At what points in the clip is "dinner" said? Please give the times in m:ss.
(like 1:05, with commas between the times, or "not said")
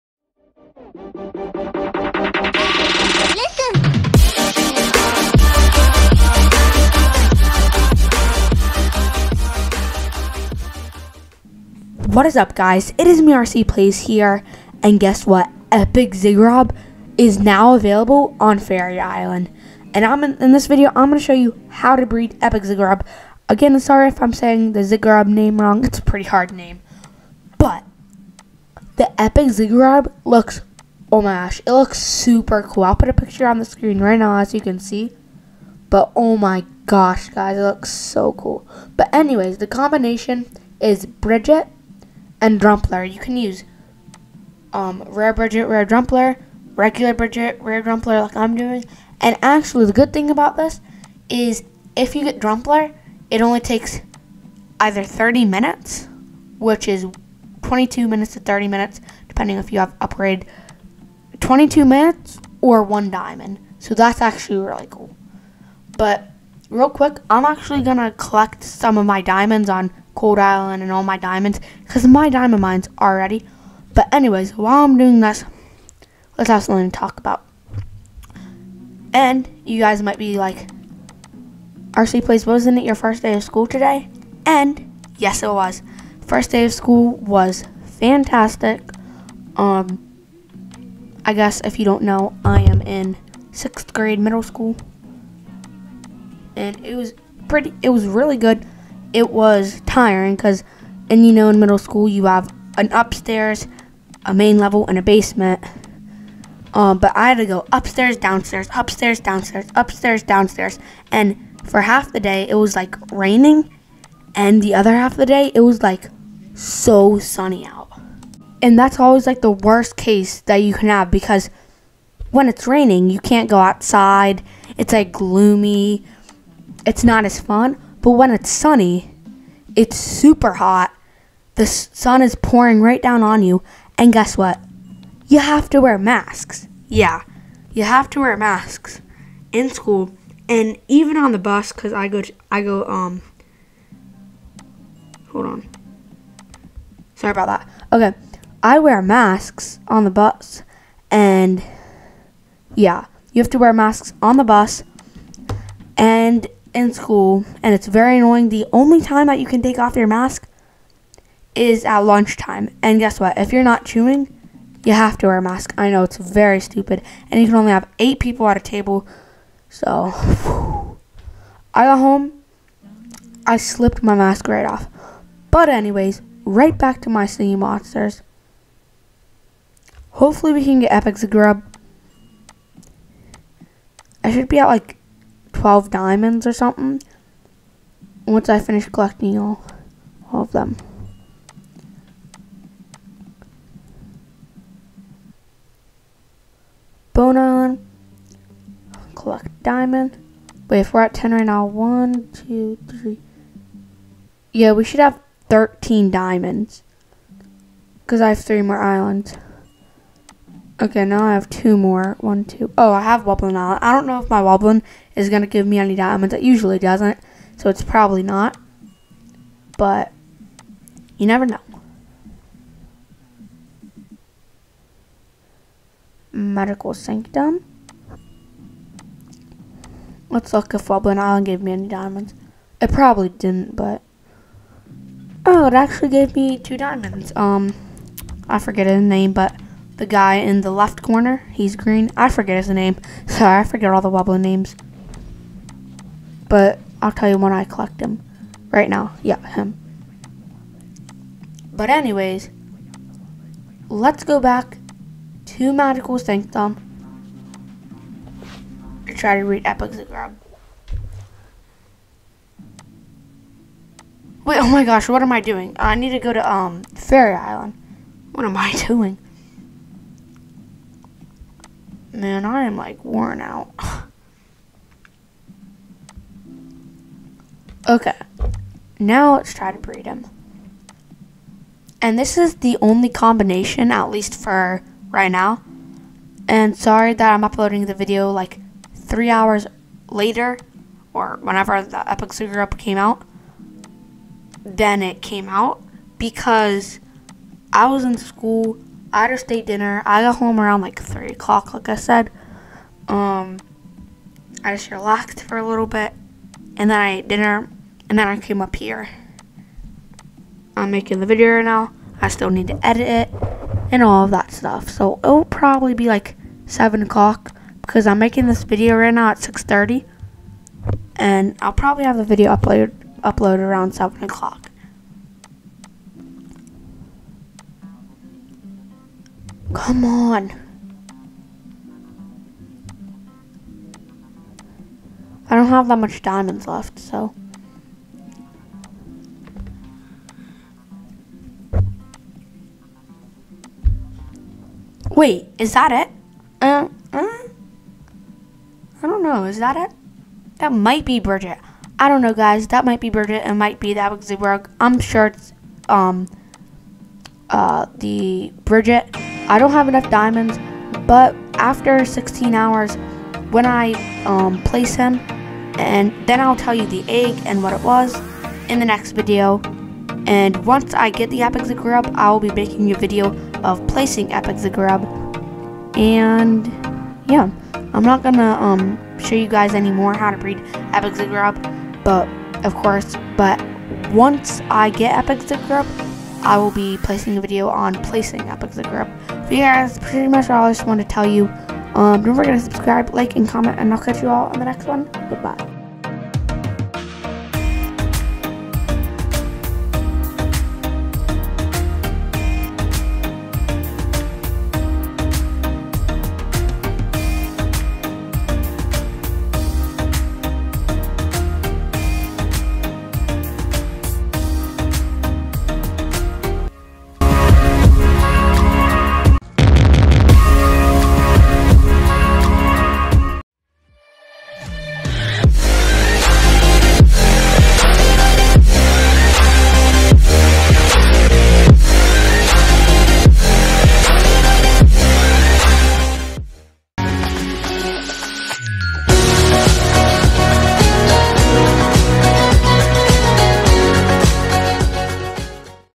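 4:59, 5:07.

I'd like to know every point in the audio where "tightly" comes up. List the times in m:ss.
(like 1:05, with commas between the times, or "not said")
not said.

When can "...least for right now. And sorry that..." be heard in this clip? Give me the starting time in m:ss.
4:44.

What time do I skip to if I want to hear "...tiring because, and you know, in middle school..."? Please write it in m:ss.
1:39.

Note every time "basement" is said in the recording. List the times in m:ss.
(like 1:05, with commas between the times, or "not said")
1:45.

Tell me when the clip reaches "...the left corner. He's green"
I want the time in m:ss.
4:00.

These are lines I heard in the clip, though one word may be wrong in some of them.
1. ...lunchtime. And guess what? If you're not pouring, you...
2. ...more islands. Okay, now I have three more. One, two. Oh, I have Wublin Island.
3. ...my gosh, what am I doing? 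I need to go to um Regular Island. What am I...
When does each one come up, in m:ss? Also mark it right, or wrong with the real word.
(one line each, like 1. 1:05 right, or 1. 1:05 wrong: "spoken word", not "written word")
1. 2:41 wrong: "chewing", not "pouring"
2. 3:28 wrong: "two", not "three"
3. 4:24 wrong: "Fairy", not "Regular".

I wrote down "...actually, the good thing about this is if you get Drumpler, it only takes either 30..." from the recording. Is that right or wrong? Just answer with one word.
right.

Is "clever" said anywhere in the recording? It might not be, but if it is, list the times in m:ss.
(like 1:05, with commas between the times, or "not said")
not said.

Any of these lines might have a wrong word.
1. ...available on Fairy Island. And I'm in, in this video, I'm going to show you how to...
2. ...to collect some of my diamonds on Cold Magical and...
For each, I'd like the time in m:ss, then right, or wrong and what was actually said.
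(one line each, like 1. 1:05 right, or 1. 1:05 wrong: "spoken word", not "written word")
1. 0:17 right
2. 1:07 wrong: "Island", not "Magical".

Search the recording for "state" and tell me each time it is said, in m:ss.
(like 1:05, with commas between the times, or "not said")
4:59.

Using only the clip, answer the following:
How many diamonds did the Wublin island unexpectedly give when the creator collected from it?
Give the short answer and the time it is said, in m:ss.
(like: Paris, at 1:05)
2, at 3:56.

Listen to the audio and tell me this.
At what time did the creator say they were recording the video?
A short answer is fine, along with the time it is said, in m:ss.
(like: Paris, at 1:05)
6:30, at 5:19.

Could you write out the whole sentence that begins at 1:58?
And that's always like the worst case that you can have because when it's raining, you can't go outside.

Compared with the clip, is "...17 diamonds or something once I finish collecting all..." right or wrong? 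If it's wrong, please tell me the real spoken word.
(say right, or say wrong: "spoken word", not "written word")
wrong: "12", not "17".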